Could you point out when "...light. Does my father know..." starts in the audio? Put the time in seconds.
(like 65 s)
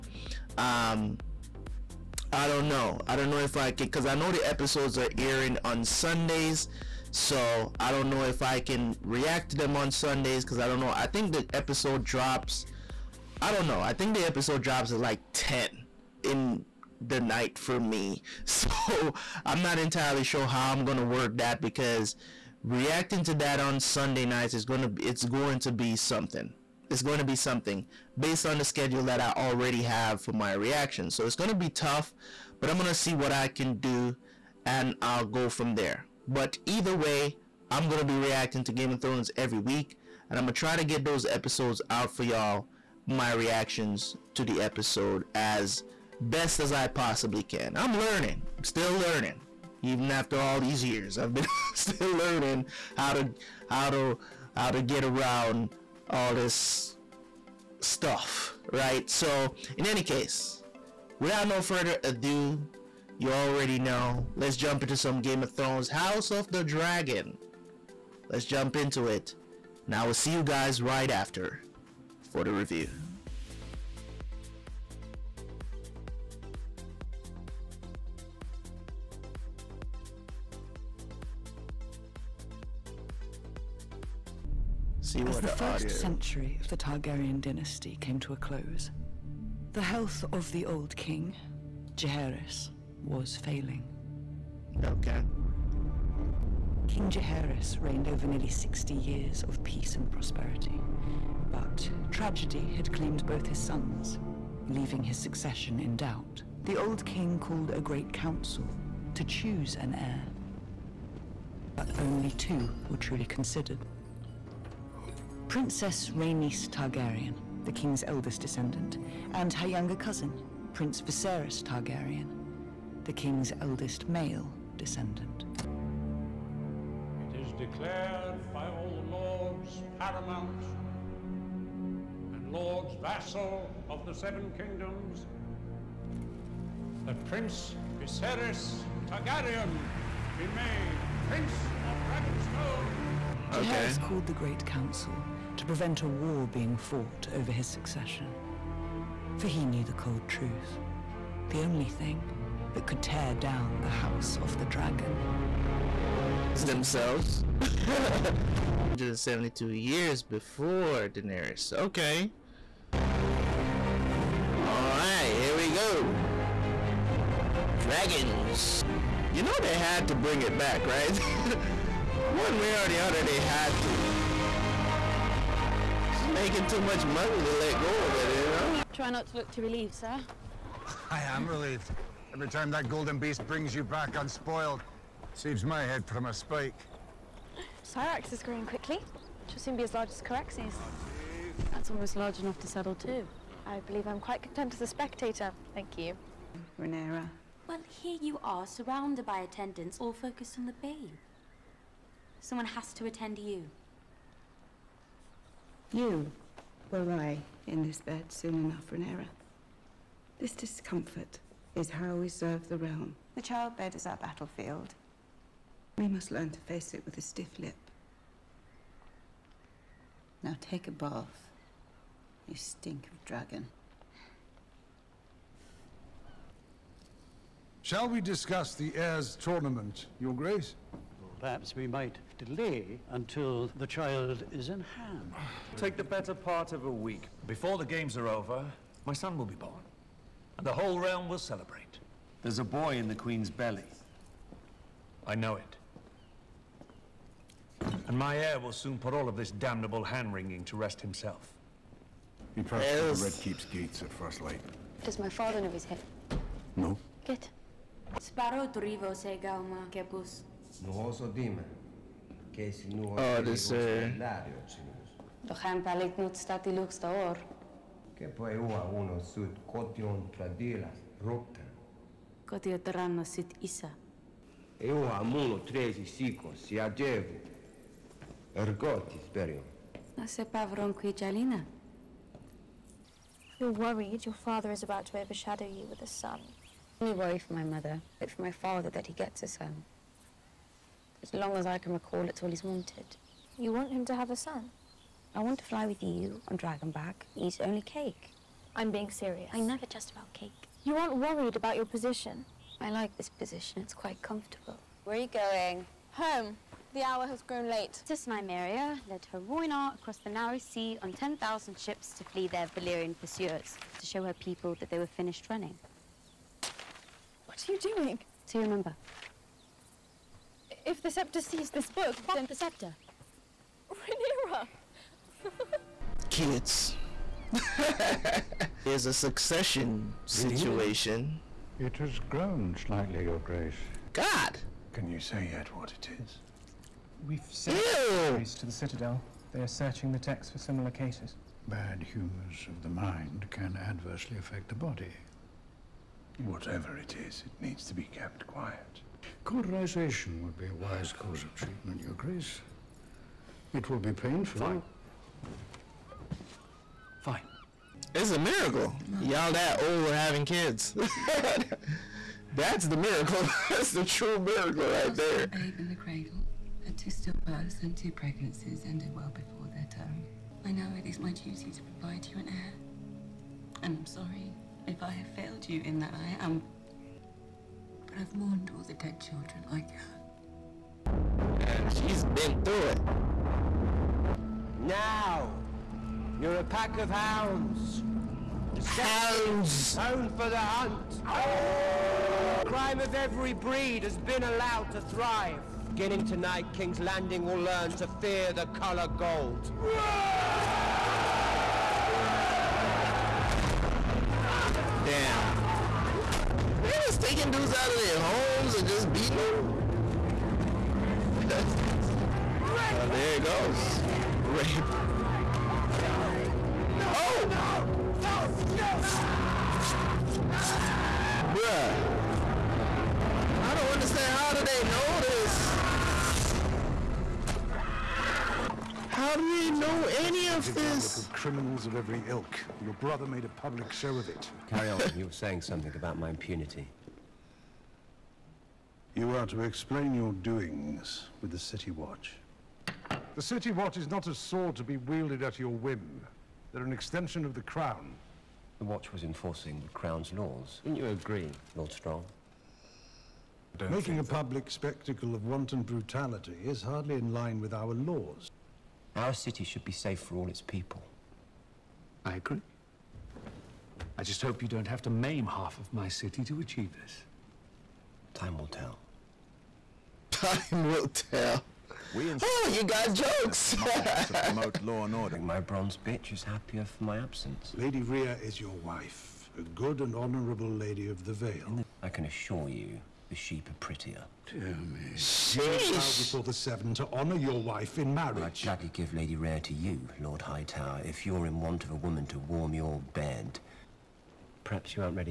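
254 s.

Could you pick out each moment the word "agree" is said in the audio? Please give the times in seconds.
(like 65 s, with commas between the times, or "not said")
451 s, 462 s.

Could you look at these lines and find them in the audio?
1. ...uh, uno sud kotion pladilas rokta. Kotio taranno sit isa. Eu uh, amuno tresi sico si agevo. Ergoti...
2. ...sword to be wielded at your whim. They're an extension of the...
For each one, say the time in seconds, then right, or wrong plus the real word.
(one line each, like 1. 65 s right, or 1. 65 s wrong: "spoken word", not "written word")
1. 268 s right
2. 444 s right.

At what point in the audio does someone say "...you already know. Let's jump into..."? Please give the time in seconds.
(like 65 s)
63 s.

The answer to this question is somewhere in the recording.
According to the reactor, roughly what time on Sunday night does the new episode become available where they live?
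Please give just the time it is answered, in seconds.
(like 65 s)
15 s.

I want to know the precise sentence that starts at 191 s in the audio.
That's almost large enough to settle too.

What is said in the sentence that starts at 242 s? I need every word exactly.
There's a boy in the Queen's belly.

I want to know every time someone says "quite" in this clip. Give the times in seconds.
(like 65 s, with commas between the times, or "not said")
194 s, 303 s.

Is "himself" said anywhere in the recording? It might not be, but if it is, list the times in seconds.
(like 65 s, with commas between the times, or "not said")
250 s.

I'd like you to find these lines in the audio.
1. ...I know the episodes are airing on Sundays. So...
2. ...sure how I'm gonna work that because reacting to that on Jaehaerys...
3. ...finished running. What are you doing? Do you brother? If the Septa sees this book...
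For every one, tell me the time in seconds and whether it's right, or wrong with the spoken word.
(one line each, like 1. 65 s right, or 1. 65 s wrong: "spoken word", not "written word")
1. 4 s right
2. 20 s wrong: "Sunday", not "Jaehaerys"
3. 315 s wrong: "remember", not "brother".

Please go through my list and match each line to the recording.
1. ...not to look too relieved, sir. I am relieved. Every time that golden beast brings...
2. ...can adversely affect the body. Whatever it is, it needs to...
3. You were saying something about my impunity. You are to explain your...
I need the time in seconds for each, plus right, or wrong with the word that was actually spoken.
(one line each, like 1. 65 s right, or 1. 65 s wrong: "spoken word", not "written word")
1. 179 s right
2. 343 s right
3. 435 s right.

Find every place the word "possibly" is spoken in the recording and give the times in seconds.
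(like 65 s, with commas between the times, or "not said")
46 s.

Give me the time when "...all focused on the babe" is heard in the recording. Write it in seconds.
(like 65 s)
199 s.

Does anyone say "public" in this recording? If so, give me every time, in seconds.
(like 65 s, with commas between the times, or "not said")
433 s, 454 s.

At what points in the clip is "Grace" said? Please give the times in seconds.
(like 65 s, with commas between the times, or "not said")
230 s, 333 s, 352 s.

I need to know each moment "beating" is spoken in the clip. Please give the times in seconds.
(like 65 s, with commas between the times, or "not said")
409 s.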